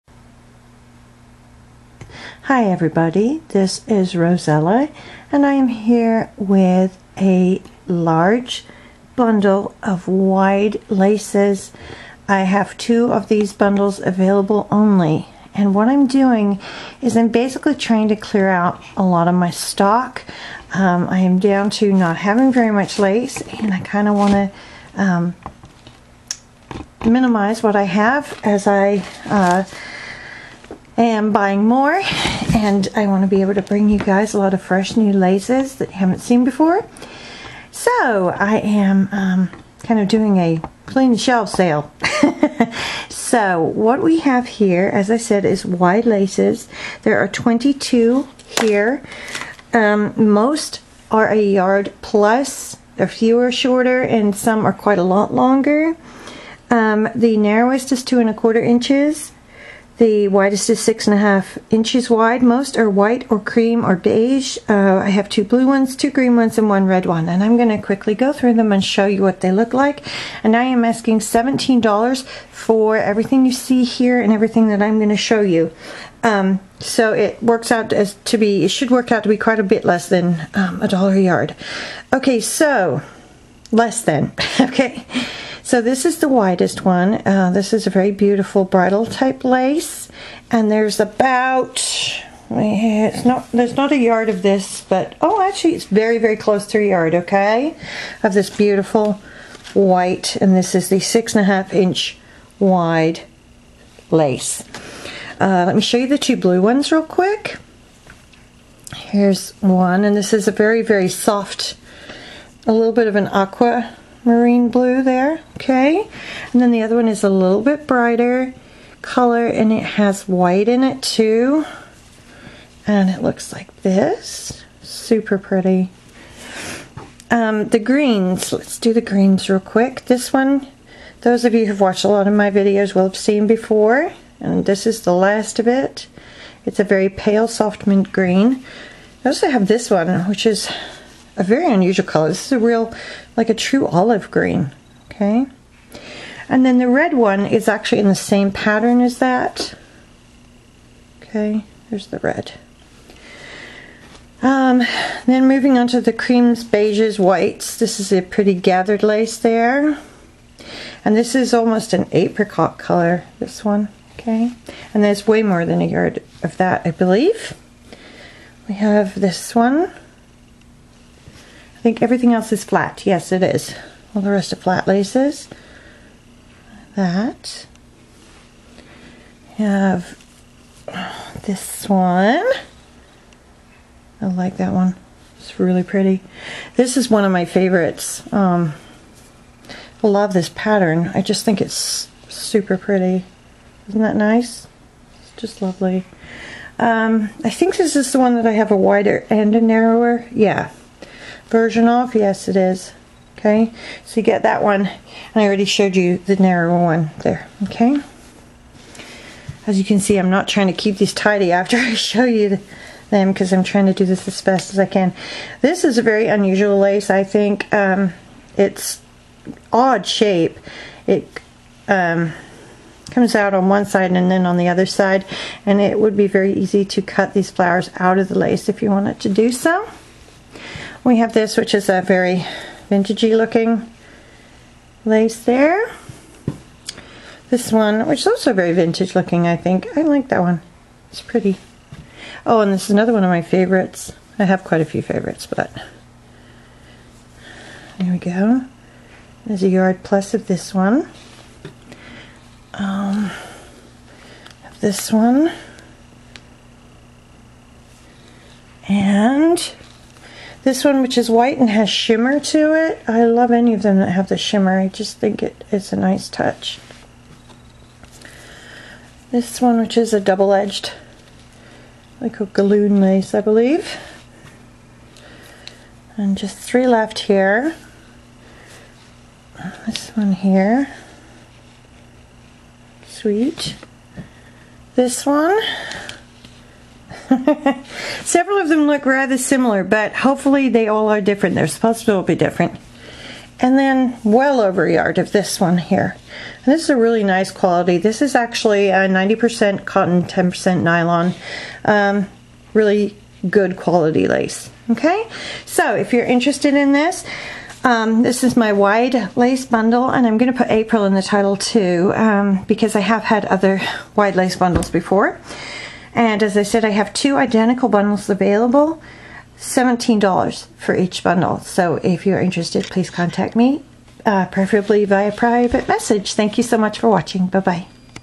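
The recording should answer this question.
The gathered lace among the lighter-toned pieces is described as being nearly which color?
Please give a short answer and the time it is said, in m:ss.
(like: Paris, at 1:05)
Apricot, at 2:42.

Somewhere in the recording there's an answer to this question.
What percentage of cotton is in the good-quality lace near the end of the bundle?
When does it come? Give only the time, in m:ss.
4:58.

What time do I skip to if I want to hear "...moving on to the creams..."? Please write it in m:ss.
2:35.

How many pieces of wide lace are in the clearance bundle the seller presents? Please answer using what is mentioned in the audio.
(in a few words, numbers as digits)
22.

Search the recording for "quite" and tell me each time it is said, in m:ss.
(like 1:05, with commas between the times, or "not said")
0:54, 1:19, 4:04.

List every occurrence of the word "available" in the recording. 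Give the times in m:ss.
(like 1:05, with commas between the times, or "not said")
0:13, 5:18.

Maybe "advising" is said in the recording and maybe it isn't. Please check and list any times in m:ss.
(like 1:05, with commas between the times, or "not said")
not said.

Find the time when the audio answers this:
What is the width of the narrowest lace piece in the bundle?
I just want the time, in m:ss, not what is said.
0:58.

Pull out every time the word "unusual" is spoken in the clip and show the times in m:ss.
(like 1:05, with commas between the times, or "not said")
2:21, 3:36.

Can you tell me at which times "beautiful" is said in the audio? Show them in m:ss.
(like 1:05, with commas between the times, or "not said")
1:28, 1:38.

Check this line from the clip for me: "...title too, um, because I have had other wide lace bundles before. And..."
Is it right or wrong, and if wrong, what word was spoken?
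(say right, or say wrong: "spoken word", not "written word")
right.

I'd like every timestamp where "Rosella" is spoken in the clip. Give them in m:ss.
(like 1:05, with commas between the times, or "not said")
0:04.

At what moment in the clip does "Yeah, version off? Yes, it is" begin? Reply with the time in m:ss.
3:20.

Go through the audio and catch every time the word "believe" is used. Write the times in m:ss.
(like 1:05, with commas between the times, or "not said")
2:46, 4:33.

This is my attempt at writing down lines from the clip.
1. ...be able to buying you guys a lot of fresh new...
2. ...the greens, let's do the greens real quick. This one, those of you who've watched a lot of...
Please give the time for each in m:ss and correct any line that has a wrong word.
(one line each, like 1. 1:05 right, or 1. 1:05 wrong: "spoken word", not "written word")
1. 0:33 wrong: "bring", not "buying"
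2. 2:07 right.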